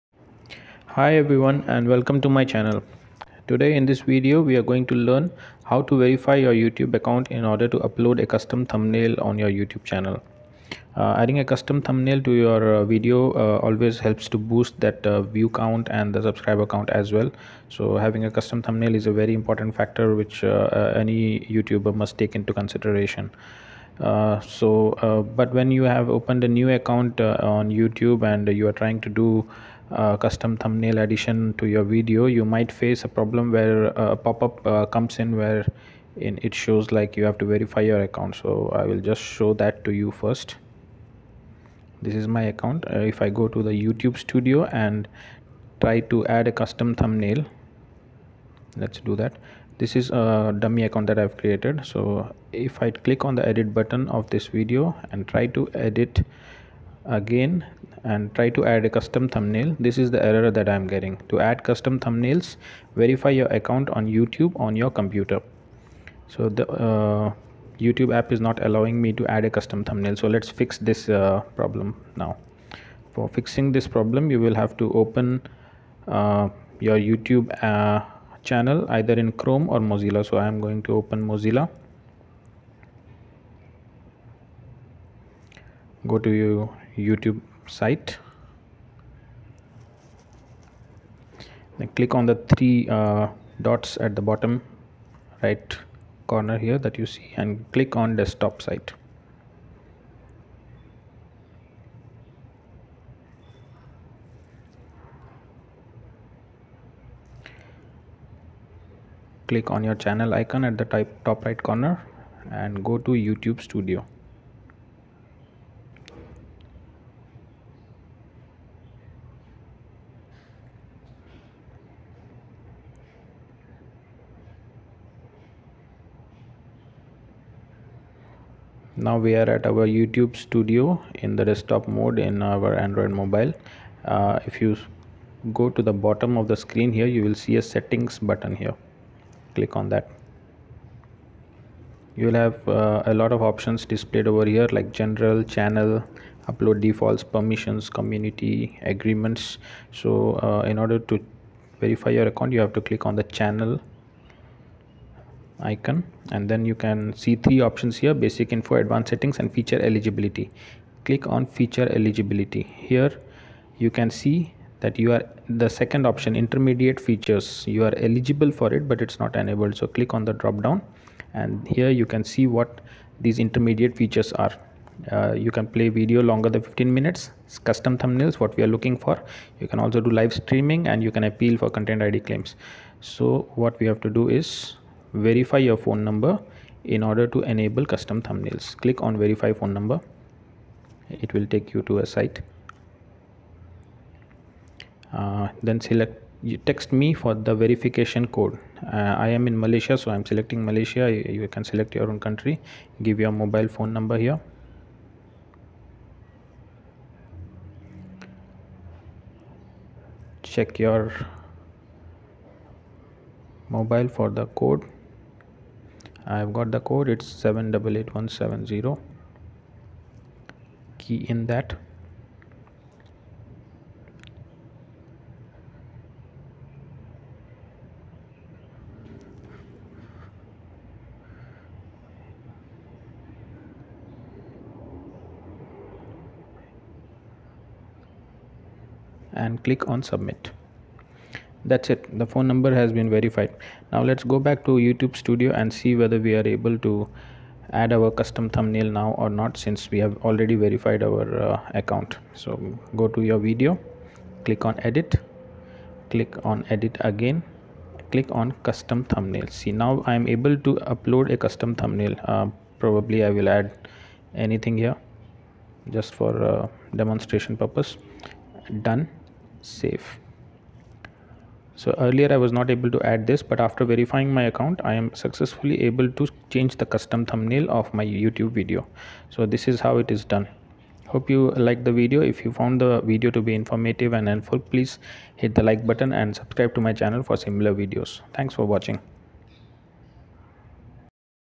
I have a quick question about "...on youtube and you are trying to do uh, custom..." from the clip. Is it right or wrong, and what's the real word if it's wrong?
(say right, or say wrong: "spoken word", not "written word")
right.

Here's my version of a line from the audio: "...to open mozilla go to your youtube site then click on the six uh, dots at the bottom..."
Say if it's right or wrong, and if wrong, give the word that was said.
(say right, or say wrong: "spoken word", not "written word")
wrong: "three", not "six".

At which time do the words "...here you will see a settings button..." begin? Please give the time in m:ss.
2:16.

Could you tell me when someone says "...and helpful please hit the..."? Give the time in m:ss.
4:44.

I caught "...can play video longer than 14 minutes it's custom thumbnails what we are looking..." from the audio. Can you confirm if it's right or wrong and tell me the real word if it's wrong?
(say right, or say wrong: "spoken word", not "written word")
wrong: "15", not "14".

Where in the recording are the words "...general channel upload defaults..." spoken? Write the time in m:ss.
2:24.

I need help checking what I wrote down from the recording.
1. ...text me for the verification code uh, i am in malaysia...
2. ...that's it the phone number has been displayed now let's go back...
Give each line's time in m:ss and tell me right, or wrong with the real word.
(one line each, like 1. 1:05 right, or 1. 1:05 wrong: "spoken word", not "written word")
1. 3:16 right
2. 4:01 wrong: "verified", not "displayed".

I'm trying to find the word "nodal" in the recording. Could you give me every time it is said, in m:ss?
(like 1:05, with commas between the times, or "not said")
not said.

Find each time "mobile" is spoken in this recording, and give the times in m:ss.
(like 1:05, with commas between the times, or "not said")
2:13, 3:23, 3:33.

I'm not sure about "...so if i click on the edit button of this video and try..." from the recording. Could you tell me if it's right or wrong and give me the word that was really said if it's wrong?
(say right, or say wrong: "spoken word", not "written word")
right.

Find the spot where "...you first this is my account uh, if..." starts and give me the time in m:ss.
0:39.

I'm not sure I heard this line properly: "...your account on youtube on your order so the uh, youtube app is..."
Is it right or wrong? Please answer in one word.
wrong.